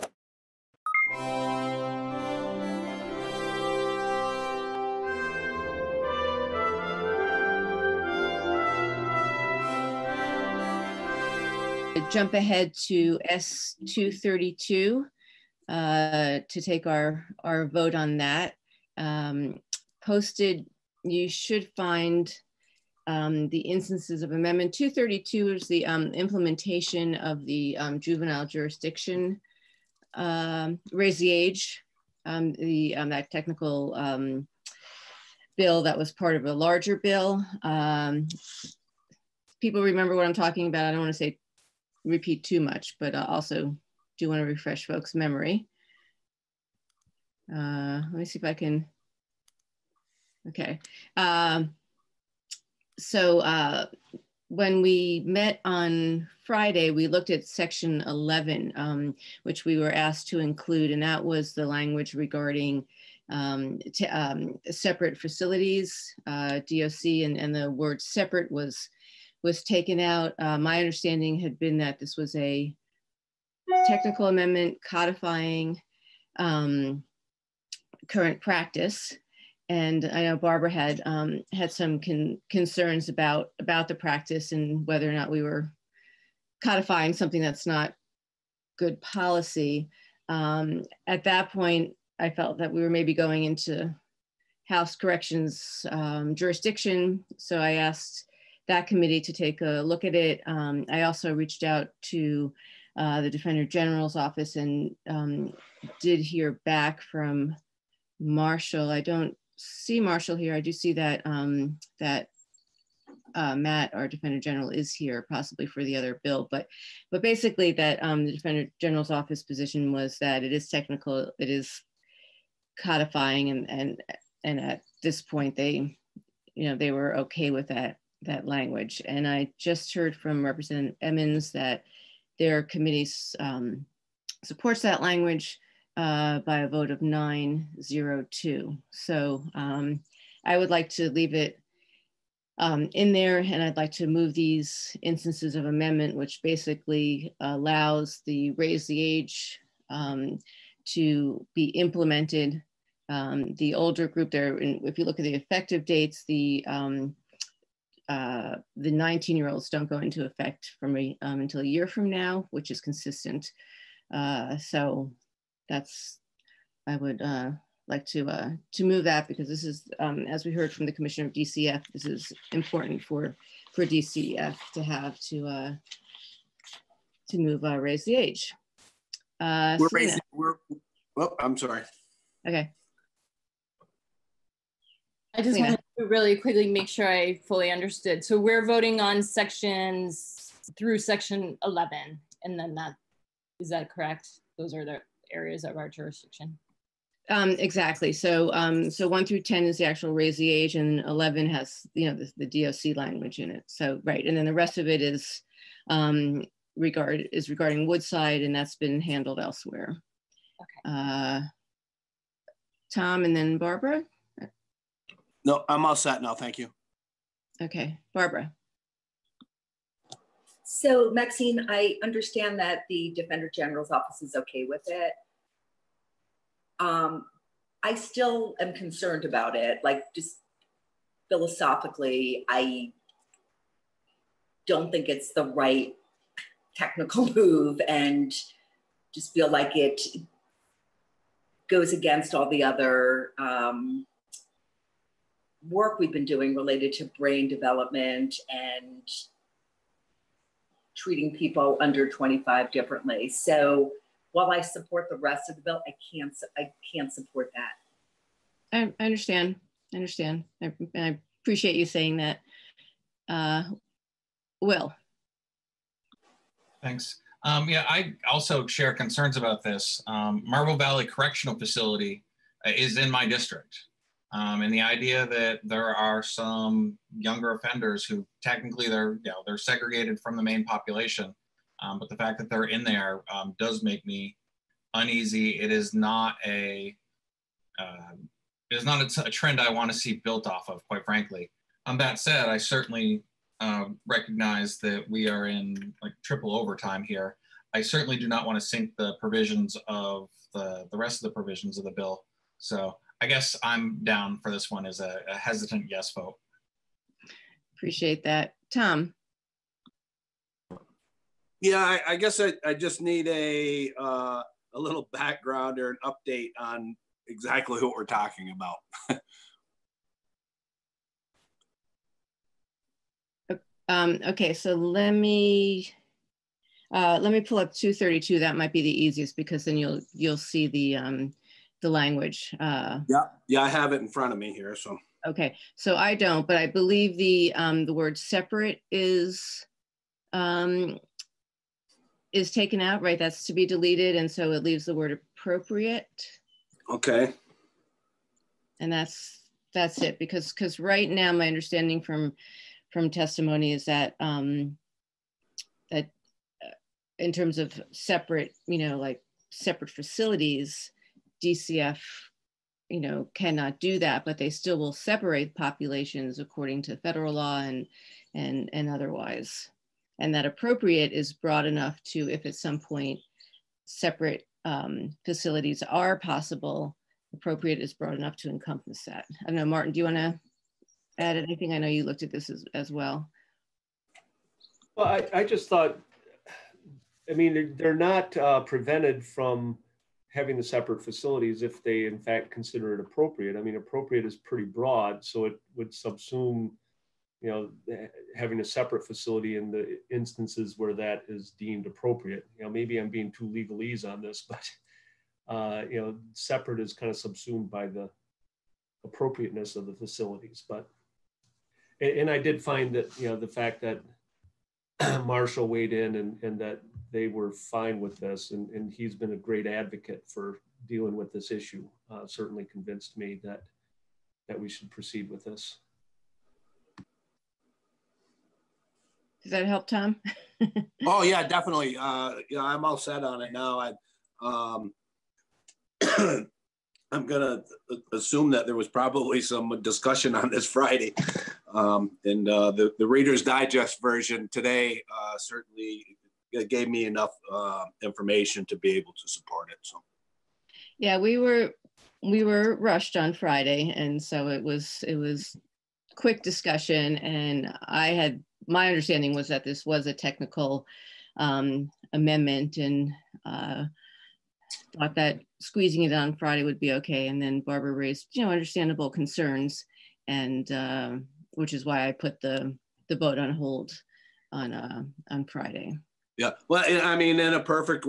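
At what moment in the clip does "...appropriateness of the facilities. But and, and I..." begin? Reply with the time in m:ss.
6:49.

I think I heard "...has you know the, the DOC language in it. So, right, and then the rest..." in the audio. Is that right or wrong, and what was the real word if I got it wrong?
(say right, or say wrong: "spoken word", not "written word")
right.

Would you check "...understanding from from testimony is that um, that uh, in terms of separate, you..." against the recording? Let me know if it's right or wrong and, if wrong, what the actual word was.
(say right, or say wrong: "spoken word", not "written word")
right.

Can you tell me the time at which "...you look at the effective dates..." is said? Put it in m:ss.
2:34.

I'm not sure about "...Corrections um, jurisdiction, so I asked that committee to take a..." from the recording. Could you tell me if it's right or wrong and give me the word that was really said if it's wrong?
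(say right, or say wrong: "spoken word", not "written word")
right.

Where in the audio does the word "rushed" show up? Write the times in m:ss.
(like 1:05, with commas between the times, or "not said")
7:32.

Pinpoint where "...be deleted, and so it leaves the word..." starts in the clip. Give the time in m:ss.
5:43.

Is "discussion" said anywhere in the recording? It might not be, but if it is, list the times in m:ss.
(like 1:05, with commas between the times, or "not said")
7:19, 7:36.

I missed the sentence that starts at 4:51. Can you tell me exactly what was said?
On um, that said, I certainly uh, recognize that we are in like triple overtime here.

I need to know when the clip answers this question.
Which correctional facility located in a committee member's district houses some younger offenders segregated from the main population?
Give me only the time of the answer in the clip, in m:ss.
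4:30.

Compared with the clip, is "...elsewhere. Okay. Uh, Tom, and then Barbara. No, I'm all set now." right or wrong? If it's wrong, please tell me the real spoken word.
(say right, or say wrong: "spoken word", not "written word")
right.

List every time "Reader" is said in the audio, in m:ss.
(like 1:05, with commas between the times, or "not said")
7:23.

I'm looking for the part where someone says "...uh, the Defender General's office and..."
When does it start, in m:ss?
1:42.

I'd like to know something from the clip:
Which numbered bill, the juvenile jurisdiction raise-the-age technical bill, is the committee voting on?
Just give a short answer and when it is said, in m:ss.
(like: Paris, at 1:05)
S232, at 0:13.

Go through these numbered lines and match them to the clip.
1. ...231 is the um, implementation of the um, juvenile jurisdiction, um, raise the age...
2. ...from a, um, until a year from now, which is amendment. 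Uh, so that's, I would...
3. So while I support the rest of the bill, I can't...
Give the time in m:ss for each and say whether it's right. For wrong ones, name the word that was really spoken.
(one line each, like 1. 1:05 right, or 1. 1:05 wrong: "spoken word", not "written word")
1. 0:24 wrong: "232", not "231"
2. 2:40 wrong: "consistent", not "amendment"
3. 4:13 right.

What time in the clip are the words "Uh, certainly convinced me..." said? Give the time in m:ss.
7:02.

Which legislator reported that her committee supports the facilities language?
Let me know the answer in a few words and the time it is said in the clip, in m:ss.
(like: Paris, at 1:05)
Representative Emmons, at 2:10.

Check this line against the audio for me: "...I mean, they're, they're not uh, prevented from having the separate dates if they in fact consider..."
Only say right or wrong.
wrong.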